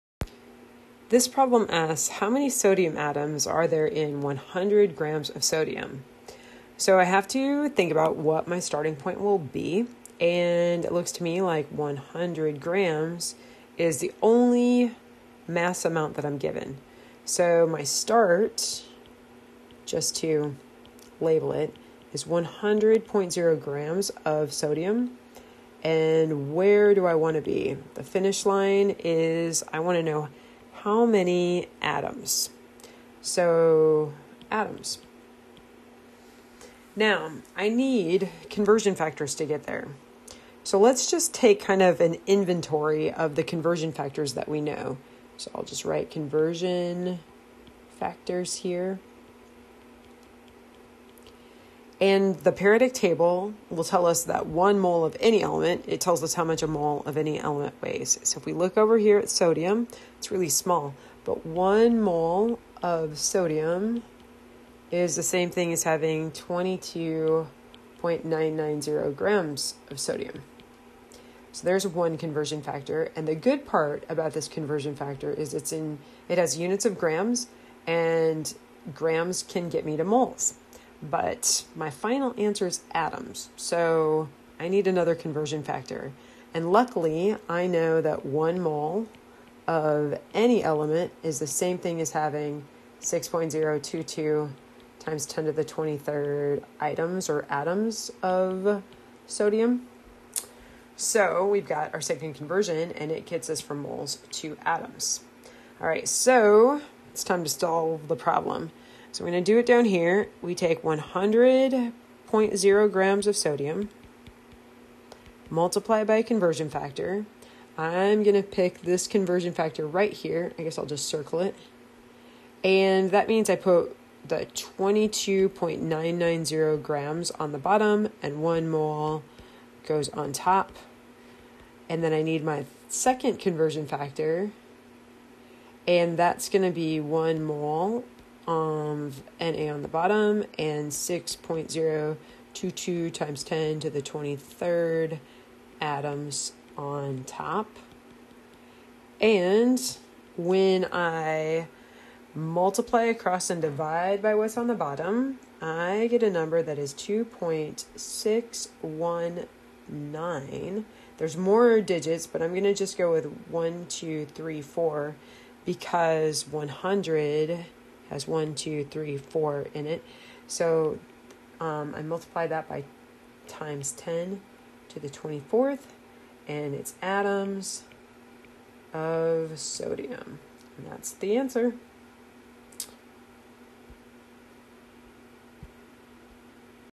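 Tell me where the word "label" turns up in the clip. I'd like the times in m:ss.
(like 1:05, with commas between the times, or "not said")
0:21.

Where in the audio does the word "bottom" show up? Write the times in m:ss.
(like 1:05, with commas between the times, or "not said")
2:07, 2:19, 2:34.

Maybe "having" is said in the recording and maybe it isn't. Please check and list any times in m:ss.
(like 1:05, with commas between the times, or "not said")
1:05, 1:32.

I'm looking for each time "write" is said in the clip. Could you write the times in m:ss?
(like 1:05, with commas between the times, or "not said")
0:45.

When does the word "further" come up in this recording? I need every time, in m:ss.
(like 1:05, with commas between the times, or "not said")
not said.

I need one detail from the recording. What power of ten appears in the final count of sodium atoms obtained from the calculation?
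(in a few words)
10 to the 24th.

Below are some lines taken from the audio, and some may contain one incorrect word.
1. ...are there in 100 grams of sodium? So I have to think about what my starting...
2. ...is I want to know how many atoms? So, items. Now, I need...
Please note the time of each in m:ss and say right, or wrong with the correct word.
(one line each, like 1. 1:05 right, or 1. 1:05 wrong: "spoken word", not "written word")
1. 0:03 right
2. 0:28 wrong: "atoms", not "items".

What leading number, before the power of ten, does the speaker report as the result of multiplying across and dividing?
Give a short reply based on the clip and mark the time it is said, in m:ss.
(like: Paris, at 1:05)
2.619, at 2:36.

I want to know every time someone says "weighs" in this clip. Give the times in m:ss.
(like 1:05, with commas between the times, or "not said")
0:57.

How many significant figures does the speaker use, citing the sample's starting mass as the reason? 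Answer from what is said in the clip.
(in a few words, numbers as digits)
4.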